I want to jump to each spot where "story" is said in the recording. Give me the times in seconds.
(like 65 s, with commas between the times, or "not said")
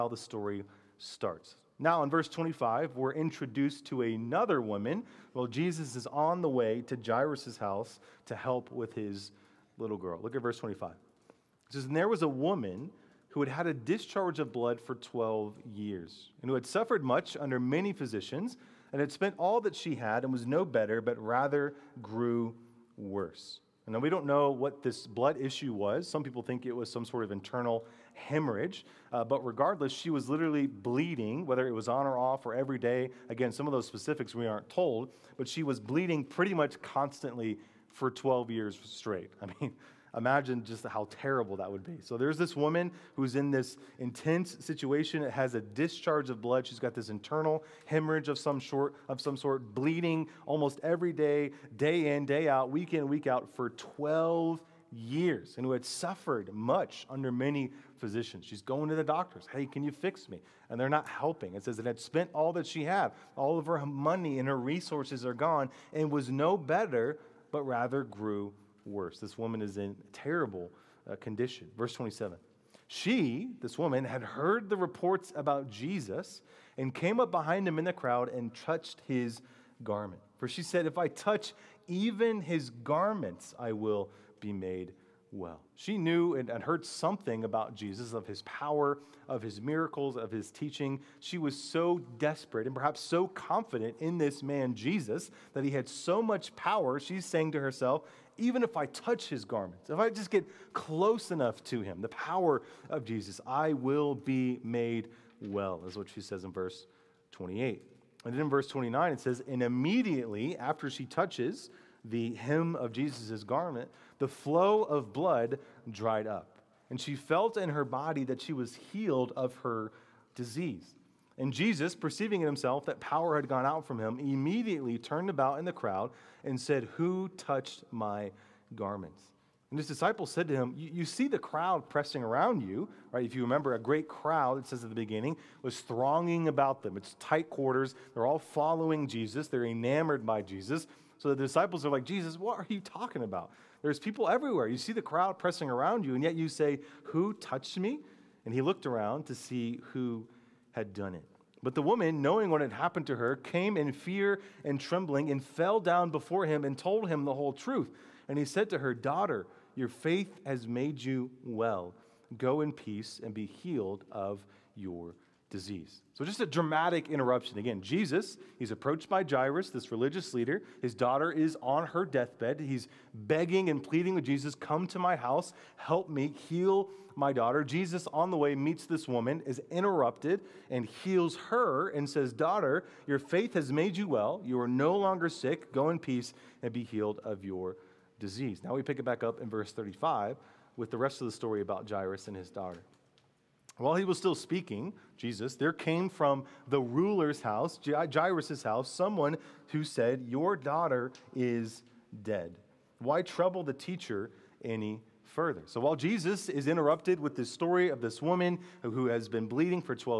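0 s, 191 s, 207 s.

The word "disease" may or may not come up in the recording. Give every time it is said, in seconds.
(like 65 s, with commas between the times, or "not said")
120 s, 165 s, 188 s.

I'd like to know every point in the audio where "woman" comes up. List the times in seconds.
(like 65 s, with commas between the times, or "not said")
4 s, 12 s, 42 s, 69 s, 73 s, 151 s, 179 s, 208 s.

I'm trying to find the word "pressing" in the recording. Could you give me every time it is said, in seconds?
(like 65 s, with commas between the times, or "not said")
131 s, 145 s.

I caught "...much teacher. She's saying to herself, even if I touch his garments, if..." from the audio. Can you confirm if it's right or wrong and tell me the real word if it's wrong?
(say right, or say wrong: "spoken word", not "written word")
wrong: "power", not "teacher".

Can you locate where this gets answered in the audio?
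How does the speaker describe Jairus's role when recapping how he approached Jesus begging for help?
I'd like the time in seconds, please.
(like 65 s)
169 s.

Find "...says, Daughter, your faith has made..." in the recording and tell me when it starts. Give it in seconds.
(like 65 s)
182 s.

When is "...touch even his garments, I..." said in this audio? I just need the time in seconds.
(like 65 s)
81 s.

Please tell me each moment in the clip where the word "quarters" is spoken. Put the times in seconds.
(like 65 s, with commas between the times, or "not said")
137 s.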